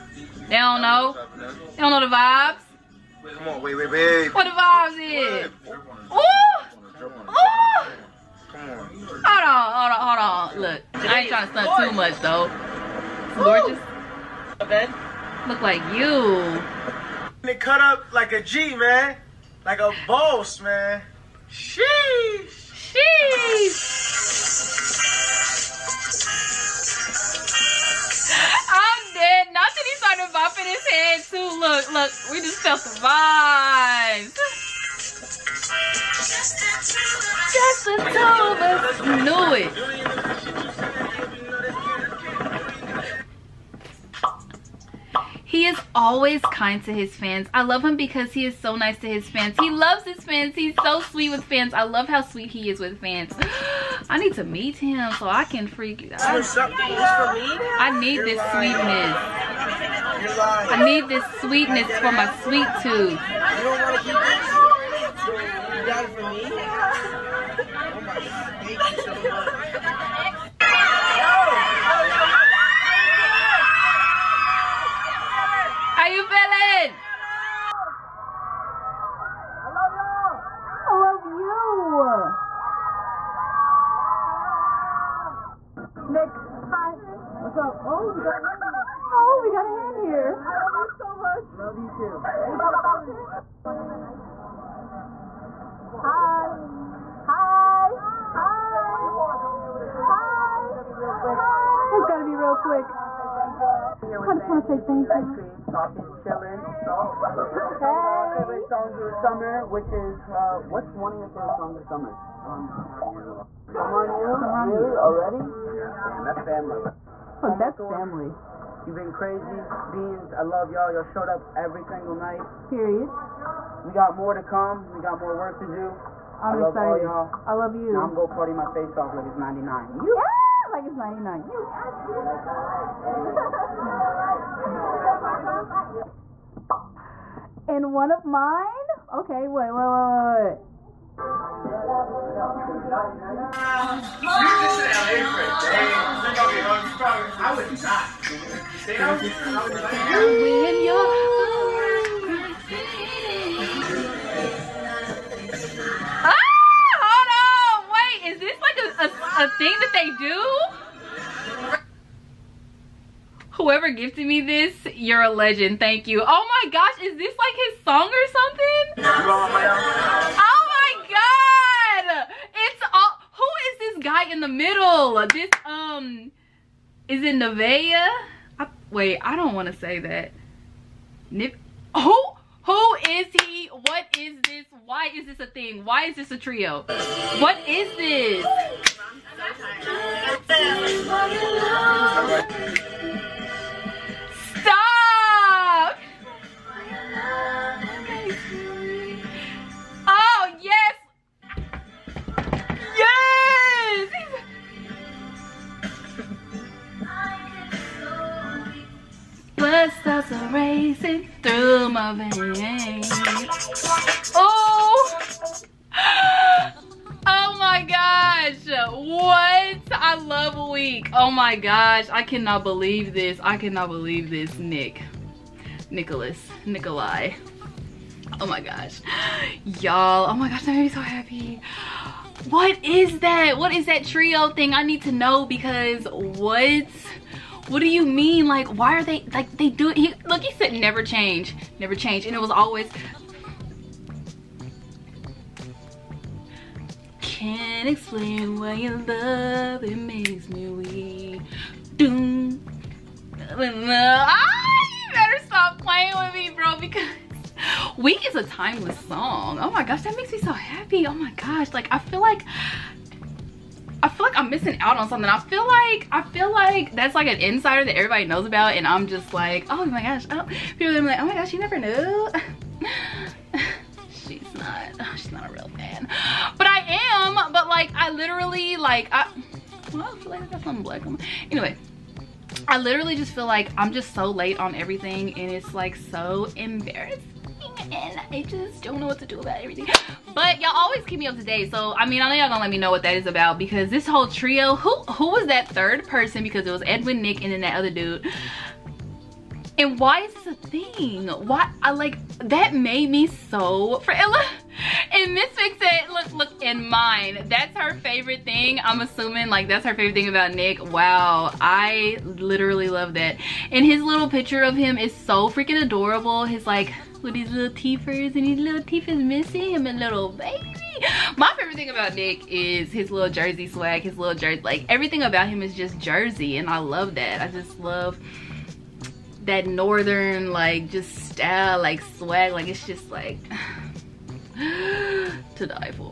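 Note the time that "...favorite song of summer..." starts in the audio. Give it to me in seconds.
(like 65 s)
108 s.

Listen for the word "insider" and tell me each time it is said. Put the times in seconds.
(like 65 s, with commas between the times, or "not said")
267 s.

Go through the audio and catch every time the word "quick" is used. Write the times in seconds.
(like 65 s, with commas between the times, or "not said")
102 s.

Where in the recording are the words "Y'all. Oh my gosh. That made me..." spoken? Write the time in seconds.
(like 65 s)
229 s.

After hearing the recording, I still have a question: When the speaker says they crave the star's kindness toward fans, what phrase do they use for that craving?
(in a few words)
sweet tooth.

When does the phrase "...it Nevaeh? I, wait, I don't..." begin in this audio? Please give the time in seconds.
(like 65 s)
177 s.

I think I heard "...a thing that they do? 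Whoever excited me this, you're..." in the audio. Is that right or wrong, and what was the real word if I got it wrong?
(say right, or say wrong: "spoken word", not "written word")
wrong: "gifted", not "excited".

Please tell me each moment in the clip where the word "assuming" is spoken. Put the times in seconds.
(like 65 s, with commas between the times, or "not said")
309 s.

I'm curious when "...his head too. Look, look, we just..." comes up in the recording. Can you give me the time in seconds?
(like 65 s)
30 s.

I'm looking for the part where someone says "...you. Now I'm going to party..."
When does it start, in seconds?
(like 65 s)
127 s.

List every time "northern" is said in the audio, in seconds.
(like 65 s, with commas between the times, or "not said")
329 s.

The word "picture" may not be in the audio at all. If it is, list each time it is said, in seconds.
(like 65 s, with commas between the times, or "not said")
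314 s.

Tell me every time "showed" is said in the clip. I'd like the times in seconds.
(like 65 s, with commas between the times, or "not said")
121 s.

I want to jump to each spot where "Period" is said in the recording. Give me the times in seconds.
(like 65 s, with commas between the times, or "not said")
122 s.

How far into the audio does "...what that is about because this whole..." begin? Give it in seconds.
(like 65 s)
292 s.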